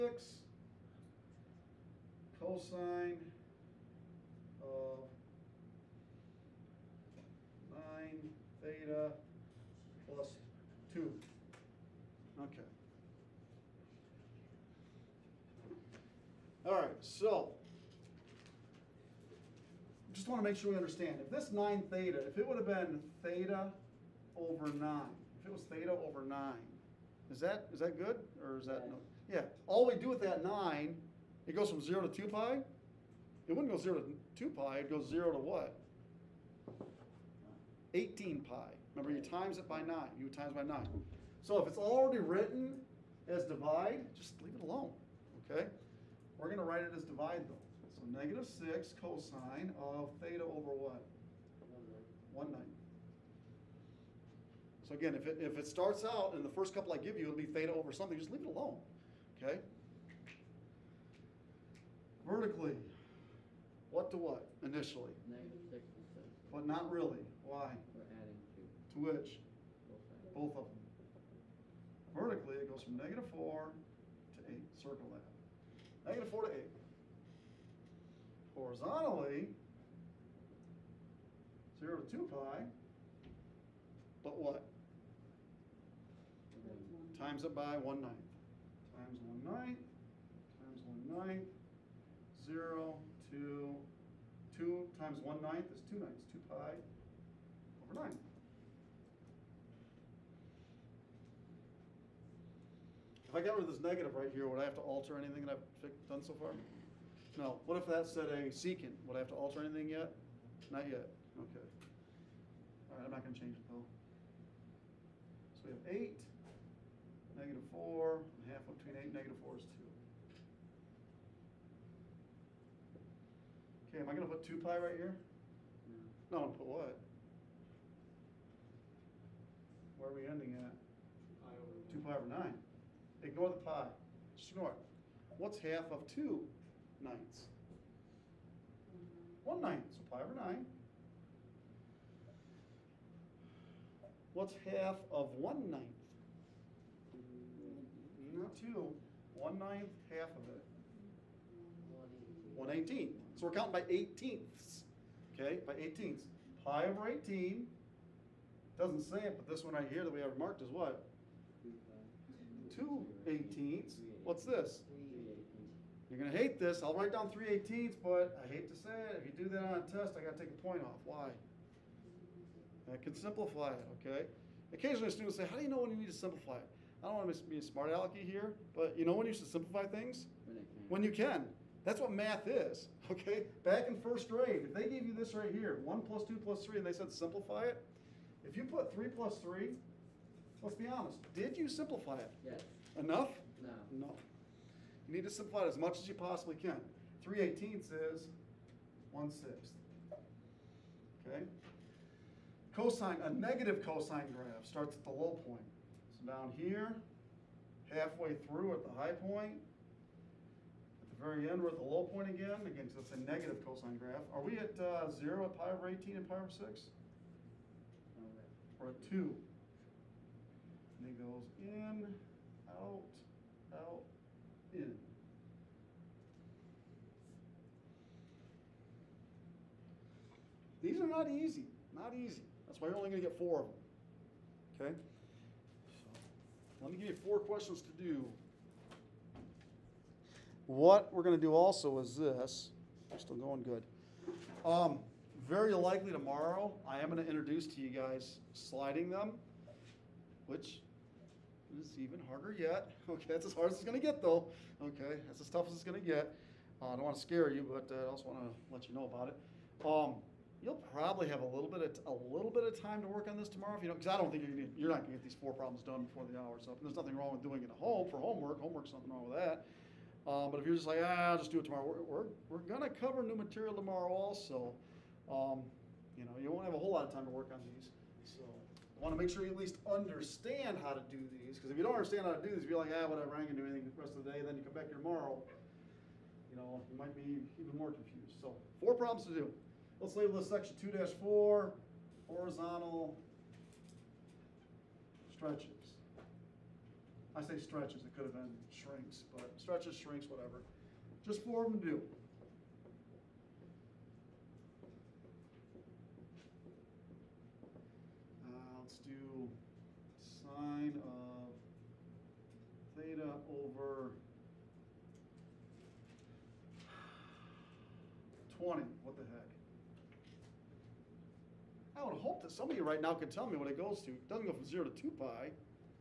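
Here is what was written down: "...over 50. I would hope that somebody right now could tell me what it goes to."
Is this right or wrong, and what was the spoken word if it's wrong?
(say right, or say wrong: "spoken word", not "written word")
wrong: "20", not "50".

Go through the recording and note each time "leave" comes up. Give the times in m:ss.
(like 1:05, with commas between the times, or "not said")
0:44, 0:58.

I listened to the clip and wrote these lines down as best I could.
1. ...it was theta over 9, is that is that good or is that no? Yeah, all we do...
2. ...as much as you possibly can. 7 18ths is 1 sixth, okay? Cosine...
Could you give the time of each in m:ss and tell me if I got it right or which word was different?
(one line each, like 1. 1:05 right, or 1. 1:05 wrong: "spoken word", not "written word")
1. 0:25 right
2. 3:15 wrong: "3", not "7".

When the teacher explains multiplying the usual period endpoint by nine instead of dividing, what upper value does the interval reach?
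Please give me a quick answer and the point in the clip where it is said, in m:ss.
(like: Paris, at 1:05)
18 pi, at 0:37.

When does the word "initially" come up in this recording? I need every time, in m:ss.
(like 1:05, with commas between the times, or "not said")
1:04.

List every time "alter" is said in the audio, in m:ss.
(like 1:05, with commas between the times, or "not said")
1:44, 1:49.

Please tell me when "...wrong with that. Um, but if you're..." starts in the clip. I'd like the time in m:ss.
4:29.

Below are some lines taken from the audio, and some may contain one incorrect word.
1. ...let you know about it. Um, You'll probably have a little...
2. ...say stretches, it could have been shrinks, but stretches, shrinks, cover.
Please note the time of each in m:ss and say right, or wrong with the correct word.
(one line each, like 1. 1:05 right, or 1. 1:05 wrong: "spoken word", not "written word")
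1. 4:18 right
2. 4:57 wrong: "whatever", not "cover".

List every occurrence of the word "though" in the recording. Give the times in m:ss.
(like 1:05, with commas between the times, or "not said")
0:47, 1:53, 4:14.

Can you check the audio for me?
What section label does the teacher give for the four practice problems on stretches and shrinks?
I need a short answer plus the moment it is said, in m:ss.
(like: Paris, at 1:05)
2-4, at 4:50.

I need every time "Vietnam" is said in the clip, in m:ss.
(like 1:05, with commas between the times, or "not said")
not said.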